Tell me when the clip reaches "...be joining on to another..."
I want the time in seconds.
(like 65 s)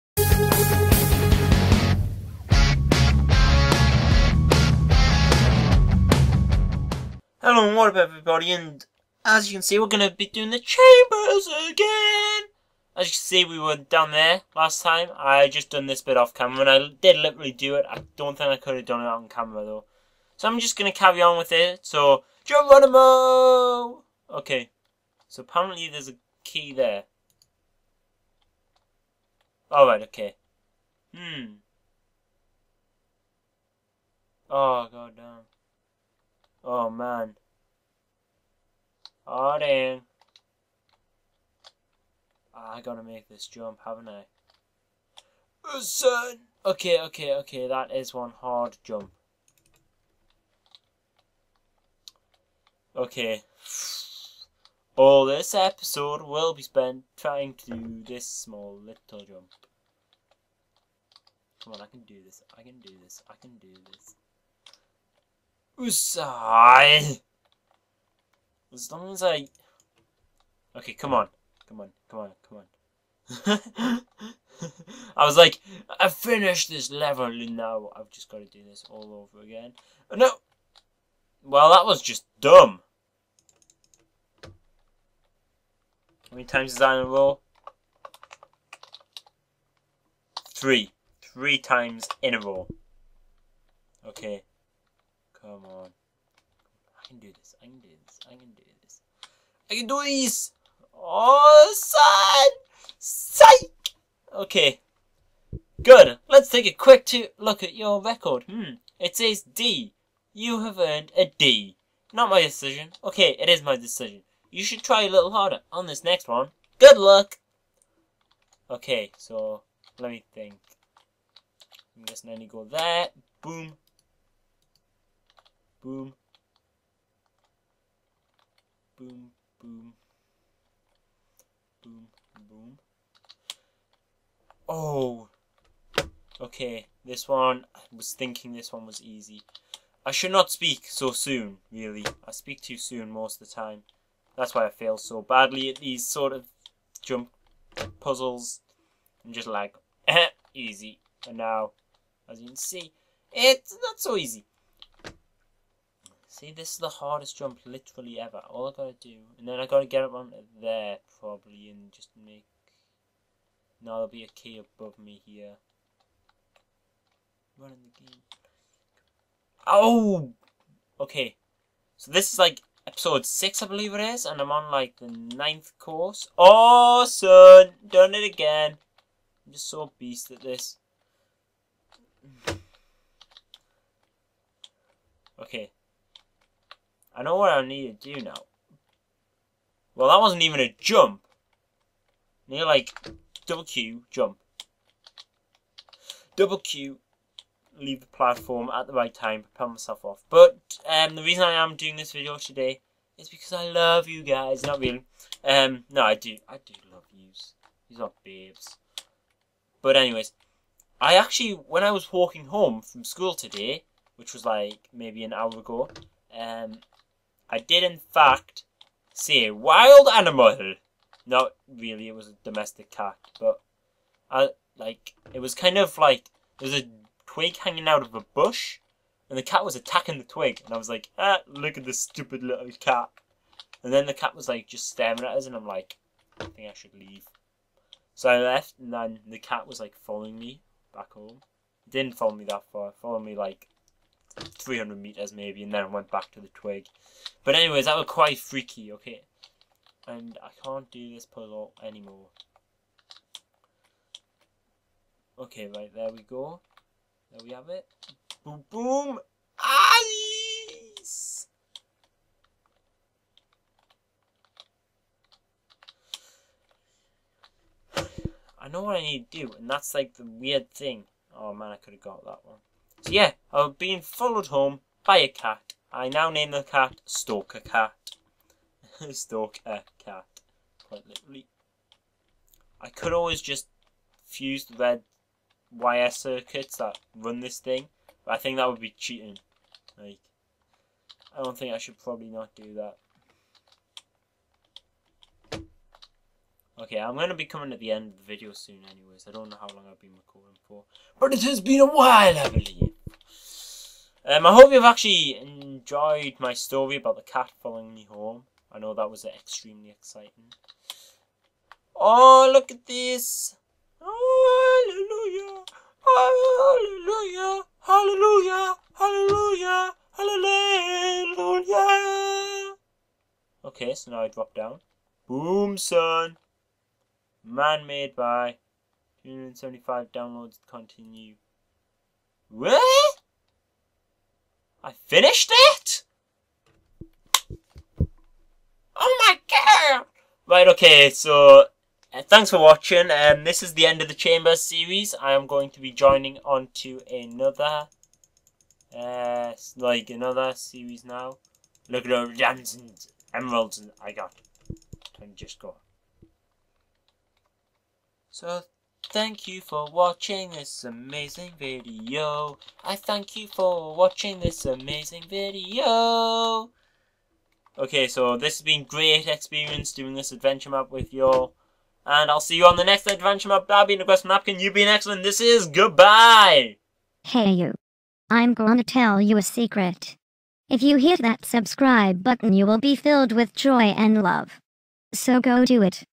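345 s.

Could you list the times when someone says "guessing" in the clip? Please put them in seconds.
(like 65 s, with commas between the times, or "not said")
122 s.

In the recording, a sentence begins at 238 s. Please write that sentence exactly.
So I left, and then the cat was like following me back home.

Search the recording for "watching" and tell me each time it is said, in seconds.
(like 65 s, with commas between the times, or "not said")
342 s, 359 s, 363 s.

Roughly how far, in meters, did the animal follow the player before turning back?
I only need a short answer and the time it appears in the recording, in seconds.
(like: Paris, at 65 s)
300 meters, at 244 s.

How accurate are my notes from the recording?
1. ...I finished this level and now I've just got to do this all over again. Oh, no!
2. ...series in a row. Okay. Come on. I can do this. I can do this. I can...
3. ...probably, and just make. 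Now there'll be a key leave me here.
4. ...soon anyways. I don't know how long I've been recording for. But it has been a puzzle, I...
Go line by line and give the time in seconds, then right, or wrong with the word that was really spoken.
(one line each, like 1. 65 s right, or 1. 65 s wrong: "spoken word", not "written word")
1. 75 s right
2. 91 s wrong: "times", not "series"
3. 161 s wrong: "above", not "leave"
4. 298 s wrong: "while", not "puzzle".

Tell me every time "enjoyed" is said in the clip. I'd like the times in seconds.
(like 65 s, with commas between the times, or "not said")
305 s.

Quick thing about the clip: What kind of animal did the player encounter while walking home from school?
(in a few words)
Domestic cat.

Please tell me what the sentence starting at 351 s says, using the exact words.
Look at all the diamonds and emeralds I got.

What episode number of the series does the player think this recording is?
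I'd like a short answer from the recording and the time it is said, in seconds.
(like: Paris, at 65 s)
6, at 173 s.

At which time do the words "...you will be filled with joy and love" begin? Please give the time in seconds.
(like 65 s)
382 s.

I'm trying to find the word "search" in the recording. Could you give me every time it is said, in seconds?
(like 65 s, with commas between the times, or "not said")
not said.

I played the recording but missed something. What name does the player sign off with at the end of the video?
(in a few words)
Request Napkin.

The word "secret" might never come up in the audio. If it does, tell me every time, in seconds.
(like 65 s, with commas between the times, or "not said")
379 s.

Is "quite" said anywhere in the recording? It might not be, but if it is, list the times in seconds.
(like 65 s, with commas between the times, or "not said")
248 s, 280 s.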